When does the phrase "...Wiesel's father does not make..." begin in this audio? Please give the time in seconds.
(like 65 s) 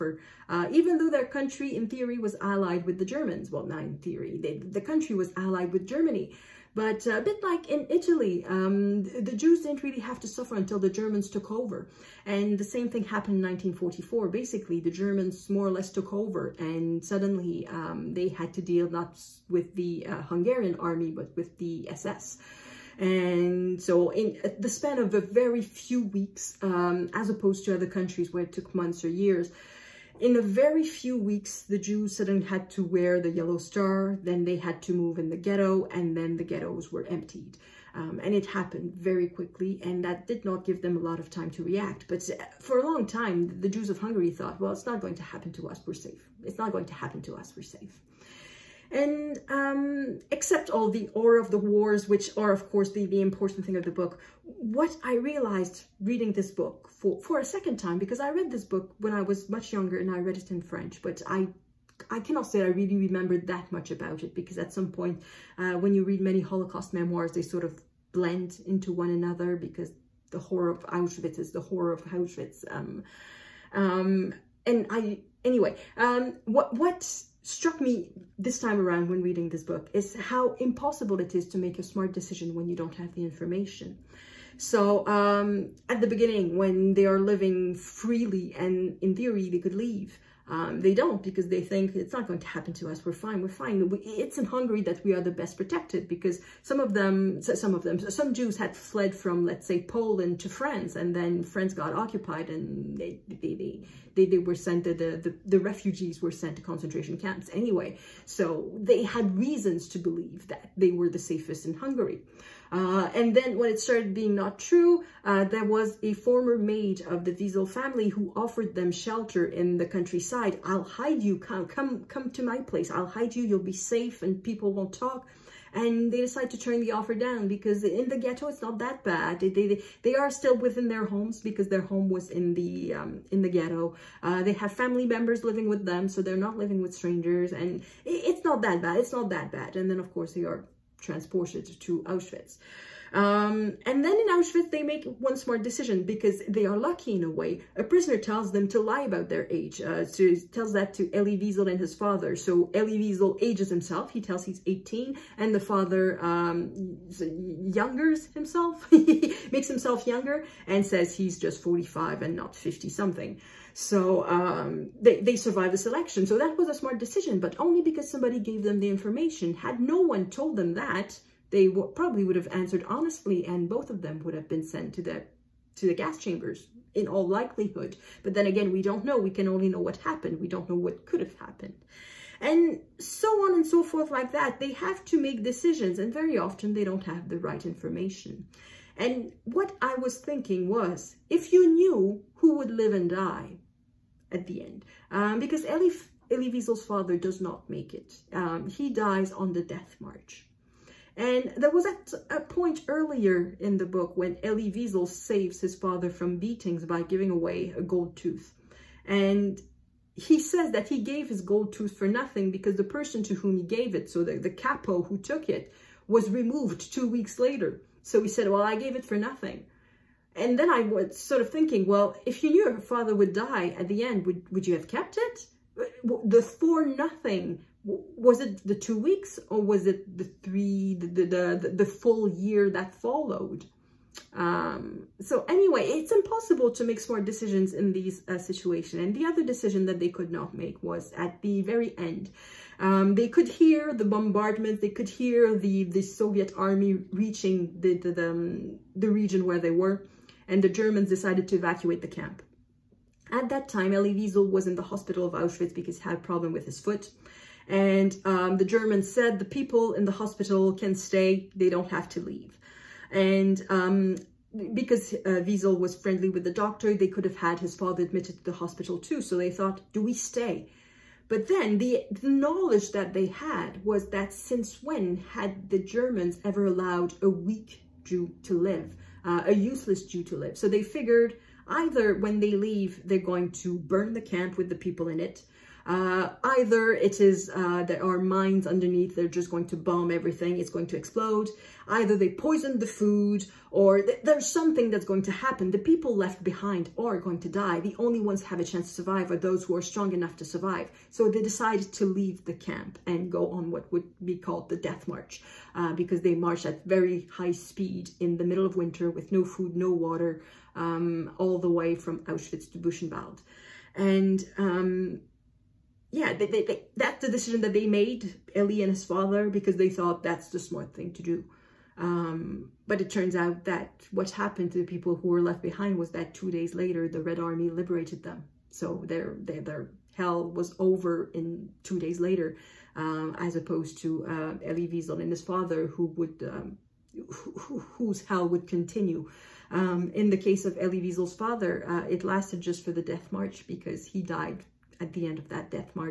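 196 s.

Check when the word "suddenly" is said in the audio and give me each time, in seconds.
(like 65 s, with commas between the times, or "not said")
17 s, 32 s.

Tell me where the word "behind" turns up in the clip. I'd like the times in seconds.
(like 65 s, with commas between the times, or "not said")
296 s, 325 s.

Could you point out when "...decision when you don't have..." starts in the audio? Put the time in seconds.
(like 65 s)
82 s.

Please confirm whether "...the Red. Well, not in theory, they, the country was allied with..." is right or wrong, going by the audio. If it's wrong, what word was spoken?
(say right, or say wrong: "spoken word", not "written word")
wrong: "Germans", not "Red".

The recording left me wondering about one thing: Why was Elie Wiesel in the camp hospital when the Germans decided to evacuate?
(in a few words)
A problem with his foot.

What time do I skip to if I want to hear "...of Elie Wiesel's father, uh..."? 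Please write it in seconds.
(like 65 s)
340 s.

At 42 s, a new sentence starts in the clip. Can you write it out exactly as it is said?
But uh, for a long time, the Jews of Hungary thought, well, it's not going to happen to us, we're safe.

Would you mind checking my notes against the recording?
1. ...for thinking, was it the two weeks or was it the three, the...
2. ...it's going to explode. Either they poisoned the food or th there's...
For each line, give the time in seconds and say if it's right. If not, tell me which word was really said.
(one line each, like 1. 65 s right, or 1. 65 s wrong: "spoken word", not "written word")
1. 226 s wrong: "nothing", not "thinking"
2. 290 s right.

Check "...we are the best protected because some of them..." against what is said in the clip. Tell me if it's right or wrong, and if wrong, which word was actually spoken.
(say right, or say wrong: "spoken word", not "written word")
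right.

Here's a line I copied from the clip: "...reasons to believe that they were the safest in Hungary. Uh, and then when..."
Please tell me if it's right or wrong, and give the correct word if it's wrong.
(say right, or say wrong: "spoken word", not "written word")
right.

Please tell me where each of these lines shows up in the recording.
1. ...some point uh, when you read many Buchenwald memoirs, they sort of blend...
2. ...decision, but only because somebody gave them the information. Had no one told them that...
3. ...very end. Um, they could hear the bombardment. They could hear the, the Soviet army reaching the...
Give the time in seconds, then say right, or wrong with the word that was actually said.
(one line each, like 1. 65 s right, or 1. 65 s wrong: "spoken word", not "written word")
1. 64 s wrong: "Holocaust", not "Buchenwald"
2. 166 s right
3. 241 s right.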